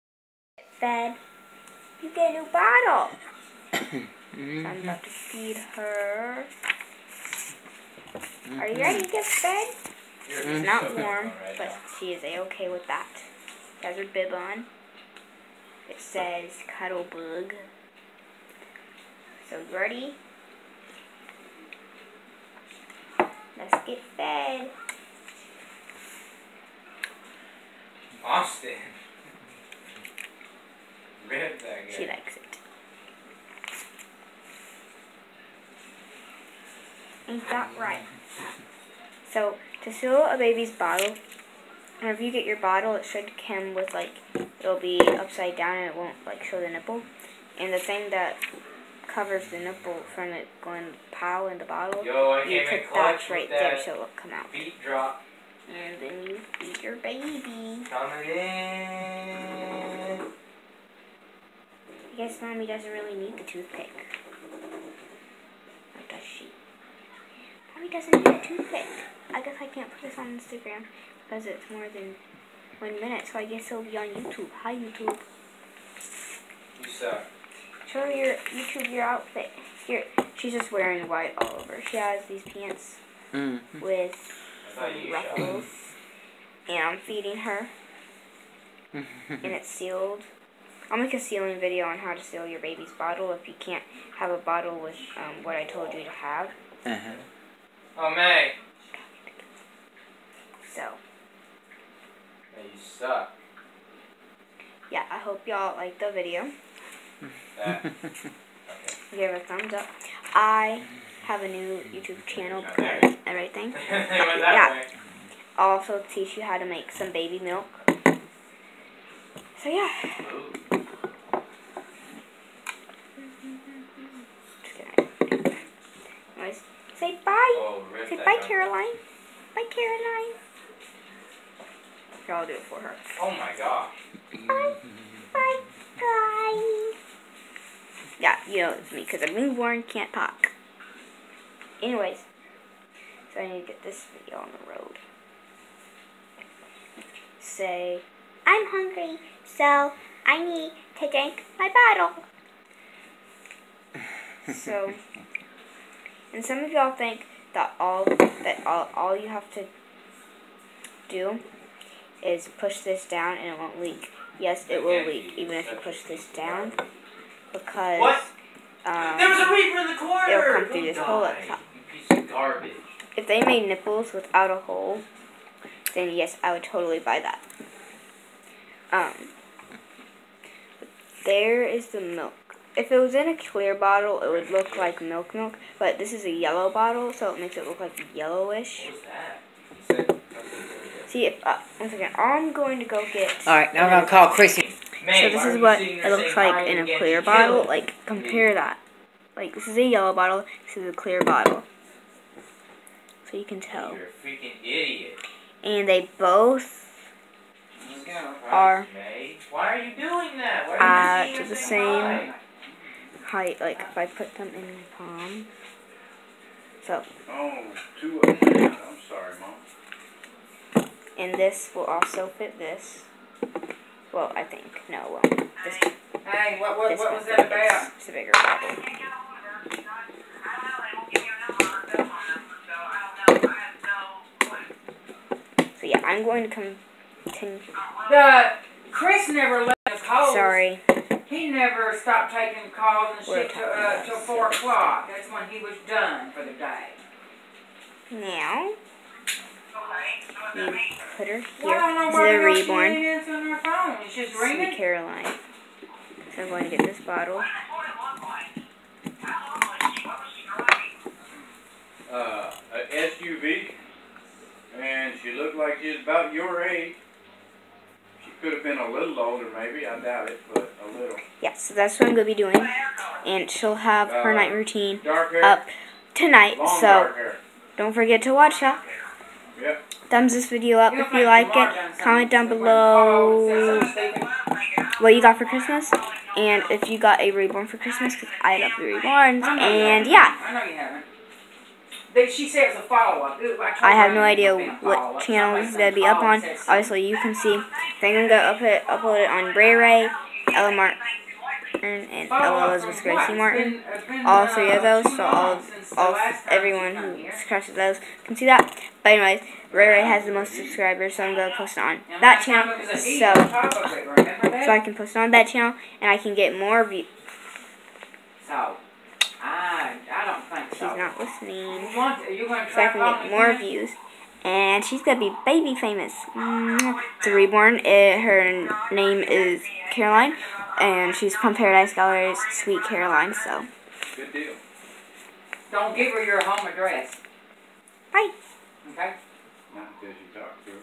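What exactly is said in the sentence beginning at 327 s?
It, her name is Caroline, and she's from Paradise Galleries, Sweet Caroline, so.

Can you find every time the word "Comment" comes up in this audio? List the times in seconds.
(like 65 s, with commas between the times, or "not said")
281 s.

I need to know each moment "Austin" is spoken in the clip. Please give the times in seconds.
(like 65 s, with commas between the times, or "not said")
28 s.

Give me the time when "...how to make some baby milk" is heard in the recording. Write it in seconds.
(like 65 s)
116 s.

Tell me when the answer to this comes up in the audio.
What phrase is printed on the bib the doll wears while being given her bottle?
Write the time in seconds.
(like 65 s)
16 s.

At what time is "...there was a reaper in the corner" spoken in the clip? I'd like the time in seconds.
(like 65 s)
169 s.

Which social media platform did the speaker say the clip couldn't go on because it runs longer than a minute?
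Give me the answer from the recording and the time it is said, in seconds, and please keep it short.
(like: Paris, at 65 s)
Instagram, at 70 s.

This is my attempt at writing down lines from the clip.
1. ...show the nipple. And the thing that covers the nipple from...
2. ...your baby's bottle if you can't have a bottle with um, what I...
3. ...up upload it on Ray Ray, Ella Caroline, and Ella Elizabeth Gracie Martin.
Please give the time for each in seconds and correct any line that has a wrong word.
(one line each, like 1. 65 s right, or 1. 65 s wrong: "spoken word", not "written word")
1. 46 s right
2. 92 s right
3. 298 s wrong: "Martin", not "Caroline".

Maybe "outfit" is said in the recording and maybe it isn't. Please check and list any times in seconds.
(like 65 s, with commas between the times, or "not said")
79 s.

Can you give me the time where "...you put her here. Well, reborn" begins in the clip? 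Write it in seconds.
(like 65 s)
250 s.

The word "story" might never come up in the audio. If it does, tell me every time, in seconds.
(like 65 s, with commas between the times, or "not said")
not said.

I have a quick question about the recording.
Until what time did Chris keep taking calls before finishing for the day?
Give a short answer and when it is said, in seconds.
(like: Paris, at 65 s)
4 o'clock, at 244 s.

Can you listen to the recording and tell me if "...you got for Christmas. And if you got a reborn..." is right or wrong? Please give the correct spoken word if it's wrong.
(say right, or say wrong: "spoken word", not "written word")
right.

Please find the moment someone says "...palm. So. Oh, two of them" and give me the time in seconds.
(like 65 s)
214 s.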